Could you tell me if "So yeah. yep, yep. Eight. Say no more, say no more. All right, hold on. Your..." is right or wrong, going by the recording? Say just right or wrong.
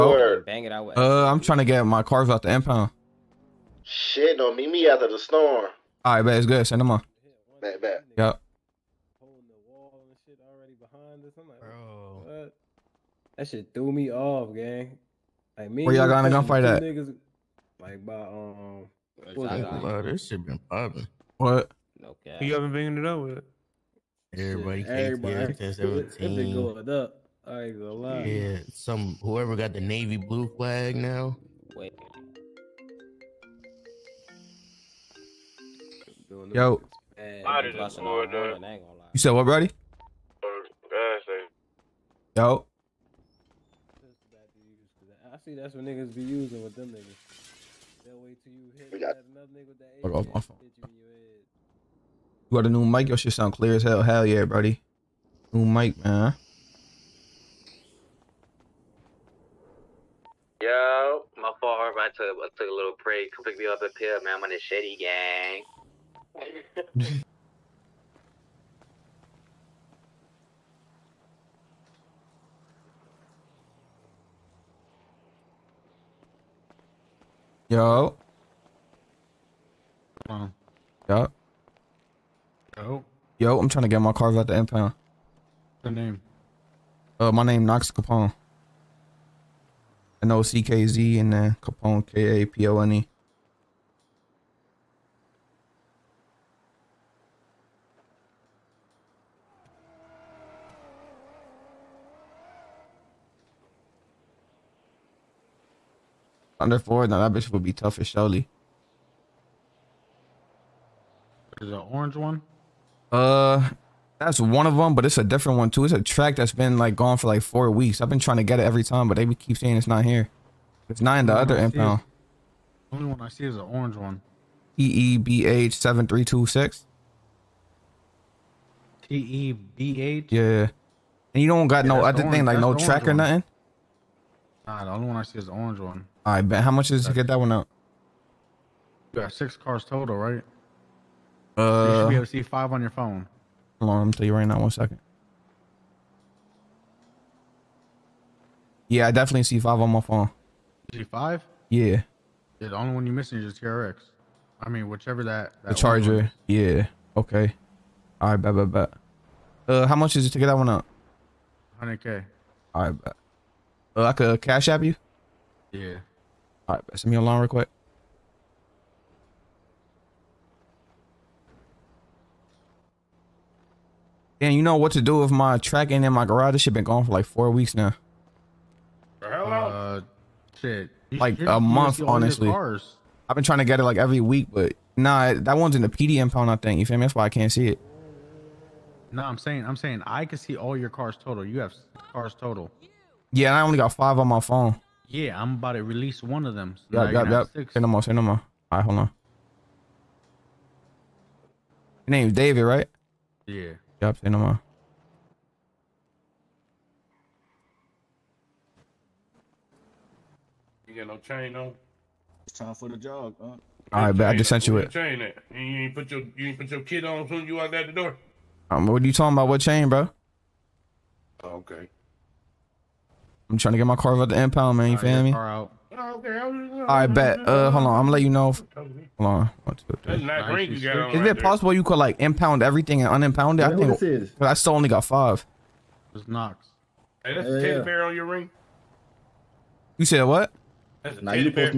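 wrong.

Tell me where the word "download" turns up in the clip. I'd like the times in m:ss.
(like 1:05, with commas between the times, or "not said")
not said.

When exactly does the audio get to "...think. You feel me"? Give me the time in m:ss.
3:06.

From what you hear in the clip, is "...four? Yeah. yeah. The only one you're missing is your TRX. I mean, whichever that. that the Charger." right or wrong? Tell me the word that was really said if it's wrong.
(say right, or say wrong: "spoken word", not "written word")
wrong: "five", not "four".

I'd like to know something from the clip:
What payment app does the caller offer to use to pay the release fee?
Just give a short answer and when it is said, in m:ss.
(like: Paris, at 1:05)
Cash App, at 2:44.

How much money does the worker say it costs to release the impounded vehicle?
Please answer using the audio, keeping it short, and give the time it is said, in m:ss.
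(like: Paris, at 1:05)
100K, at 2:41.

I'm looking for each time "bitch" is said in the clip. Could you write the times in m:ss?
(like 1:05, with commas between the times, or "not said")
1:47.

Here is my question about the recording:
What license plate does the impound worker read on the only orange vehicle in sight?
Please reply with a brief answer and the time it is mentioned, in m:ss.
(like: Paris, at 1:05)
TEBH7326, at 2:04.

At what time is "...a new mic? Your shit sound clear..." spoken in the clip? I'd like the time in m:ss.
0:52.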